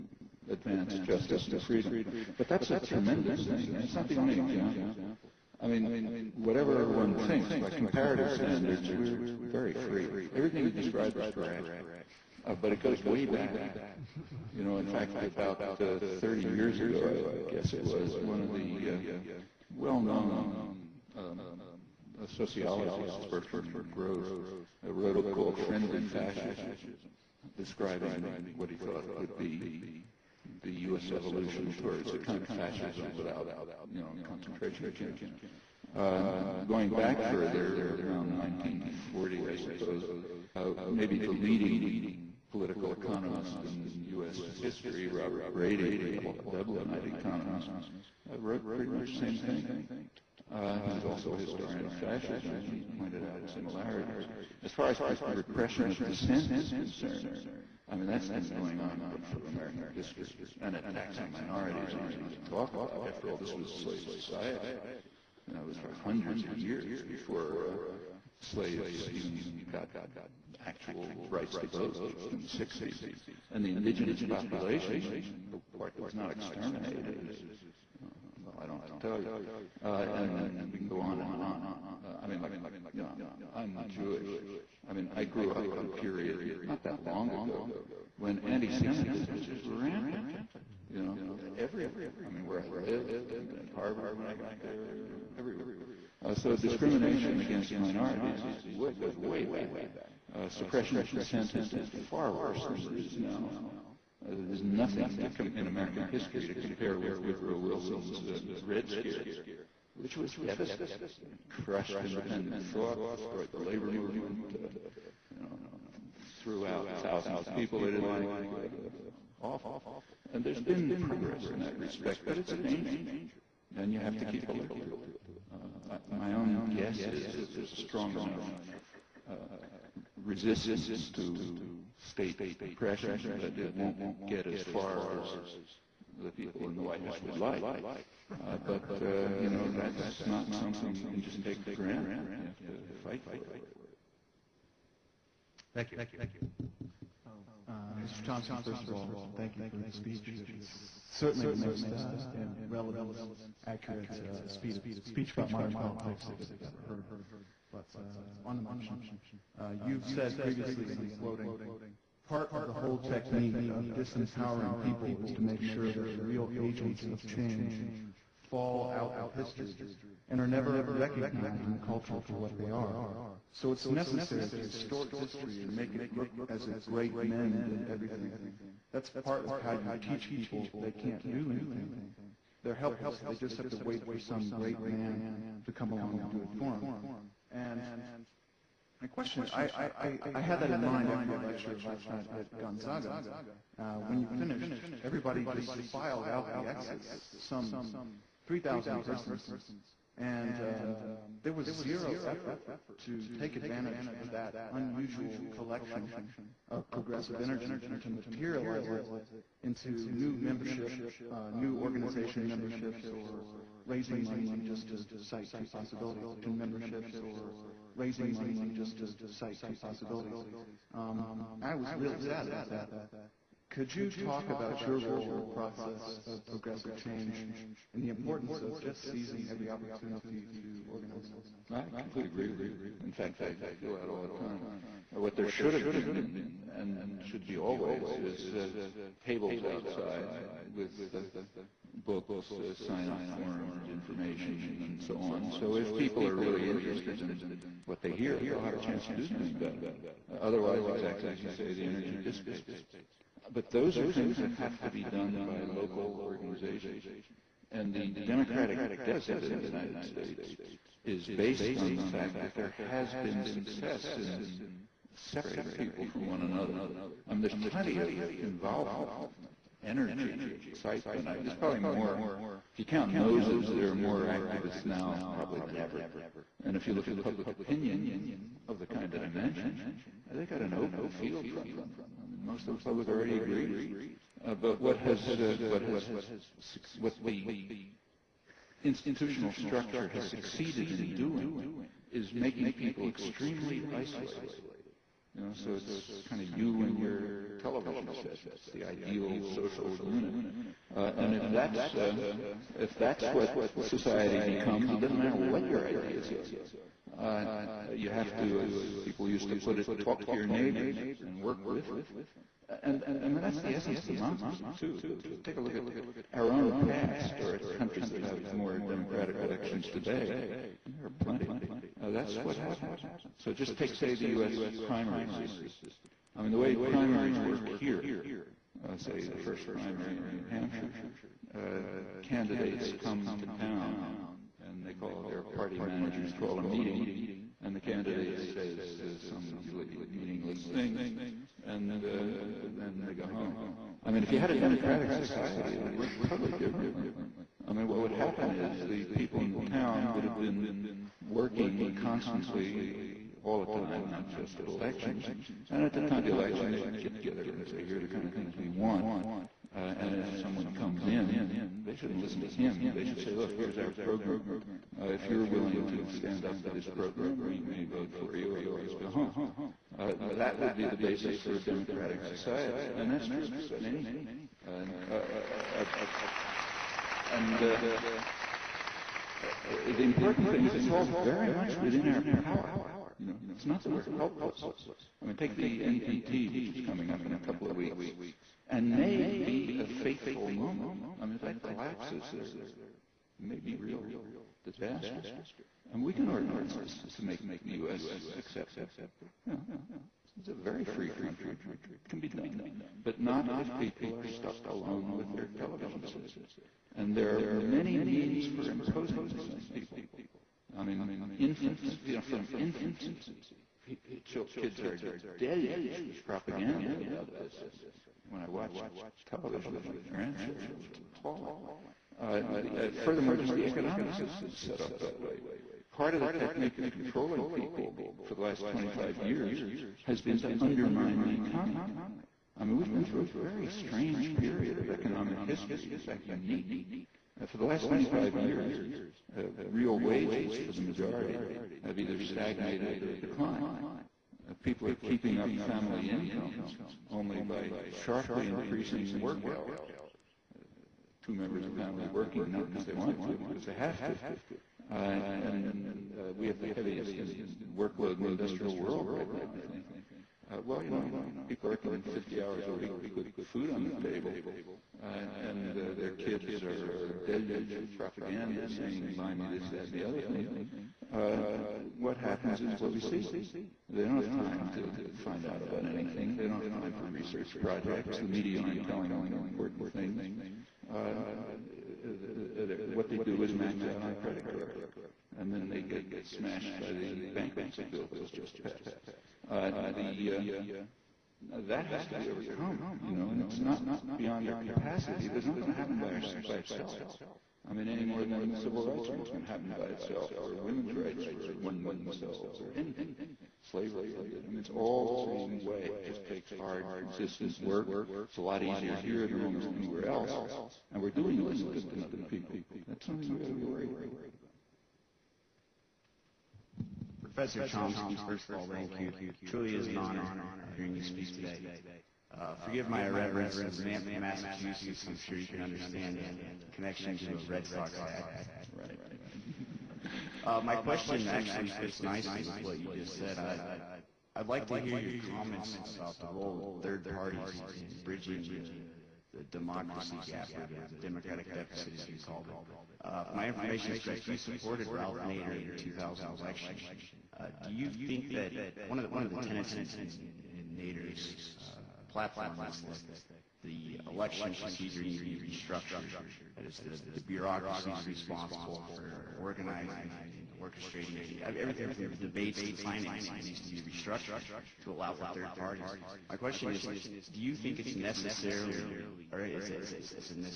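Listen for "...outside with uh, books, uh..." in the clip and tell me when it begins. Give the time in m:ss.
3:59.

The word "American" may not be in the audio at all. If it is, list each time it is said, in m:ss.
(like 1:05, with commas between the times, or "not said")
0:59, 1:45.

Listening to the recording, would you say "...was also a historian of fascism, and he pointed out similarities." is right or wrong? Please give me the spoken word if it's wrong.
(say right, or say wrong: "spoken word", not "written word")
right.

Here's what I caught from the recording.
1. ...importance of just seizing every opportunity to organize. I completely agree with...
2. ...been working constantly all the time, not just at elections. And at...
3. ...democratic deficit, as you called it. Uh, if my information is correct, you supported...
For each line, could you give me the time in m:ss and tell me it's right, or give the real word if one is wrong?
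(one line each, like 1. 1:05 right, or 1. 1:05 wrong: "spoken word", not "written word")
1. 3:48 right
2. 5:50 right
3. 9:01 right.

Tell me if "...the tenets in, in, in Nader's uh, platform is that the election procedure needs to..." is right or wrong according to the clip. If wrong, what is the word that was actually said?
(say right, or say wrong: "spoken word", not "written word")
right.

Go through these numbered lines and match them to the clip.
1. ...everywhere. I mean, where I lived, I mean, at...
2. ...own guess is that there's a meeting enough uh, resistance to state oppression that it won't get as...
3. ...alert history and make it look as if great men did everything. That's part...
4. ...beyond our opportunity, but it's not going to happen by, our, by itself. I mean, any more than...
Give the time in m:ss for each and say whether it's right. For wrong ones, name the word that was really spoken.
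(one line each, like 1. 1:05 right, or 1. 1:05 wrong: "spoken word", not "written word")
1. 1:31 right
2. 2:06 wrong: "strong", not "meeting"
3. 2:54 wrong: "distort", not "alert"
4. 8:14 wrong: "capacity", not "opportunity".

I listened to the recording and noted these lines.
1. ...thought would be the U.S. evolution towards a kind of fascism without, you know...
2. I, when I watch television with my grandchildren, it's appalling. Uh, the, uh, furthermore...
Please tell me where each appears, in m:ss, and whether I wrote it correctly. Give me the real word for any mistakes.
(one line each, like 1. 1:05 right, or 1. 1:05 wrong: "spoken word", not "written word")
1. 0:28 right
2. 6:57 right.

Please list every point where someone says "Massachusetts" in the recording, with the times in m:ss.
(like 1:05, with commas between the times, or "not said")
8:44.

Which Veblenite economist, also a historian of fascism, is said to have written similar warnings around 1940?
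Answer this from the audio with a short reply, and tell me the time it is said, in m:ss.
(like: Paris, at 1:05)
Robert Brady, at 0:45.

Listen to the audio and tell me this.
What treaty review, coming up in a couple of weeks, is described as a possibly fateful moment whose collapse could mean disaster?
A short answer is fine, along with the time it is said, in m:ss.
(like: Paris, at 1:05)
NPT, at 6:25.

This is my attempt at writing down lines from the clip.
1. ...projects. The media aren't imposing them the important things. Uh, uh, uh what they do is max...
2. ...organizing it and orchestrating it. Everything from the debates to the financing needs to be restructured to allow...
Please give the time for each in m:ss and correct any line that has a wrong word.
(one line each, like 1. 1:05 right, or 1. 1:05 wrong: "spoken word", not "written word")
1. 7:57 wrong: "telling", not "imposing"
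2. 9:19 right.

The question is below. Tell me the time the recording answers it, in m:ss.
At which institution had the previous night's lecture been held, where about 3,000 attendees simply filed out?
3:12.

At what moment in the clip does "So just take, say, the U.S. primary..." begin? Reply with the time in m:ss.
5:23.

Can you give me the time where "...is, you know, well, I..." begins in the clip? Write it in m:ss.
1:17.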